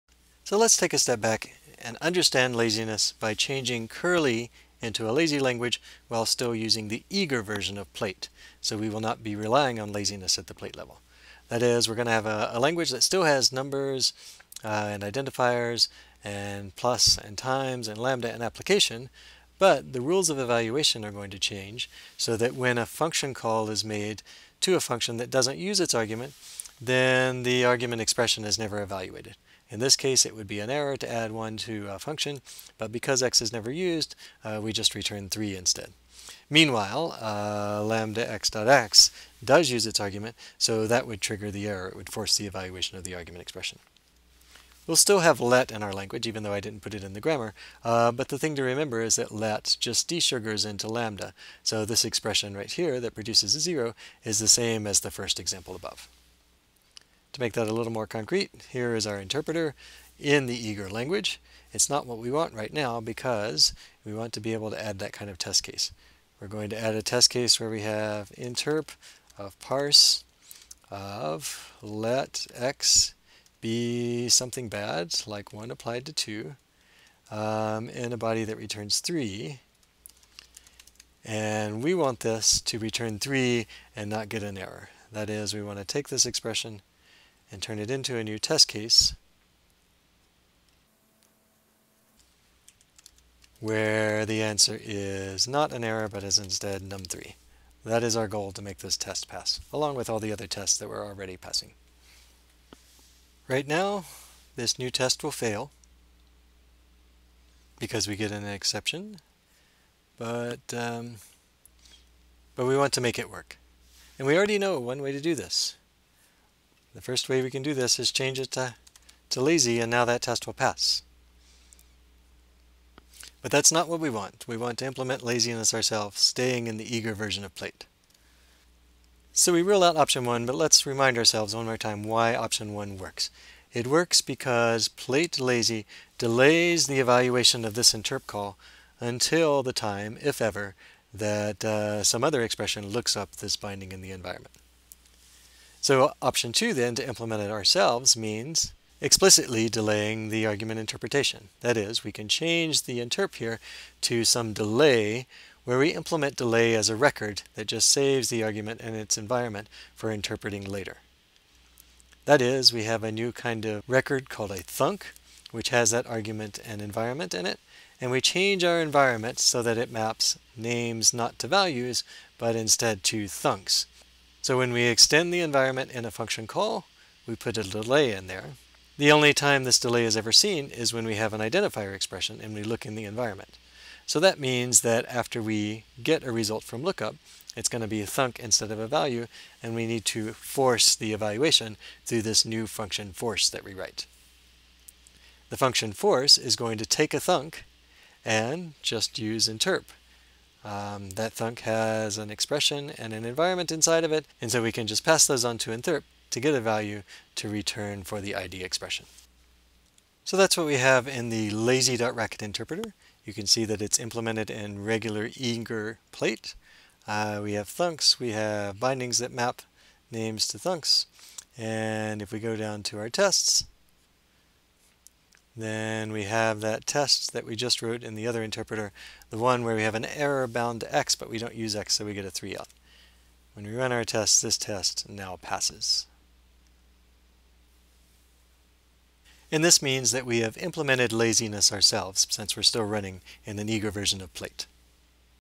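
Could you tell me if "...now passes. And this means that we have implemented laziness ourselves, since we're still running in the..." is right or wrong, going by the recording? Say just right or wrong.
right.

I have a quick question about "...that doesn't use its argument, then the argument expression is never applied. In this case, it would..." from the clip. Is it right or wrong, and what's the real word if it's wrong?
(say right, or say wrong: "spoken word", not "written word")
wrong: "evaluated", not "applied".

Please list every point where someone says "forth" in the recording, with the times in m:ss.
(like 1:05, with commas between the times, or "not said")
not said.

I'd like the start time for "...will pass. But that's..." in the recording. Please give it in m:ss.
2:00.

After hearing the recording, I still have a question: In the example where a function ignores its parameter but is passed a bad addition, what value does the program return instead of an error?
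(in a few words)
3.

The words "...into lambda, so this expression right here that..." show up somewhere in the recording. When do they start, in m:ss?
0:50.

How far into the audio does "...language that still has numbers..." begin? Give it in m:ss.
0:12.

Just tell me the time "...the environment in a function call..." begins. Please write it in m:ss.
2:55.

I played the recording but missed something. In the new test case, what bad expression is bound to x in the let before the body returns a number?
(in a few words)
1 applied to 2.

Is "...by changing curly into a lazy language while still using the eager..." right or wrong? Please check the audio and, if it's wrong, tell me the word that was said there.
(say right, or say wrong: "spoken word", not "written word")
right.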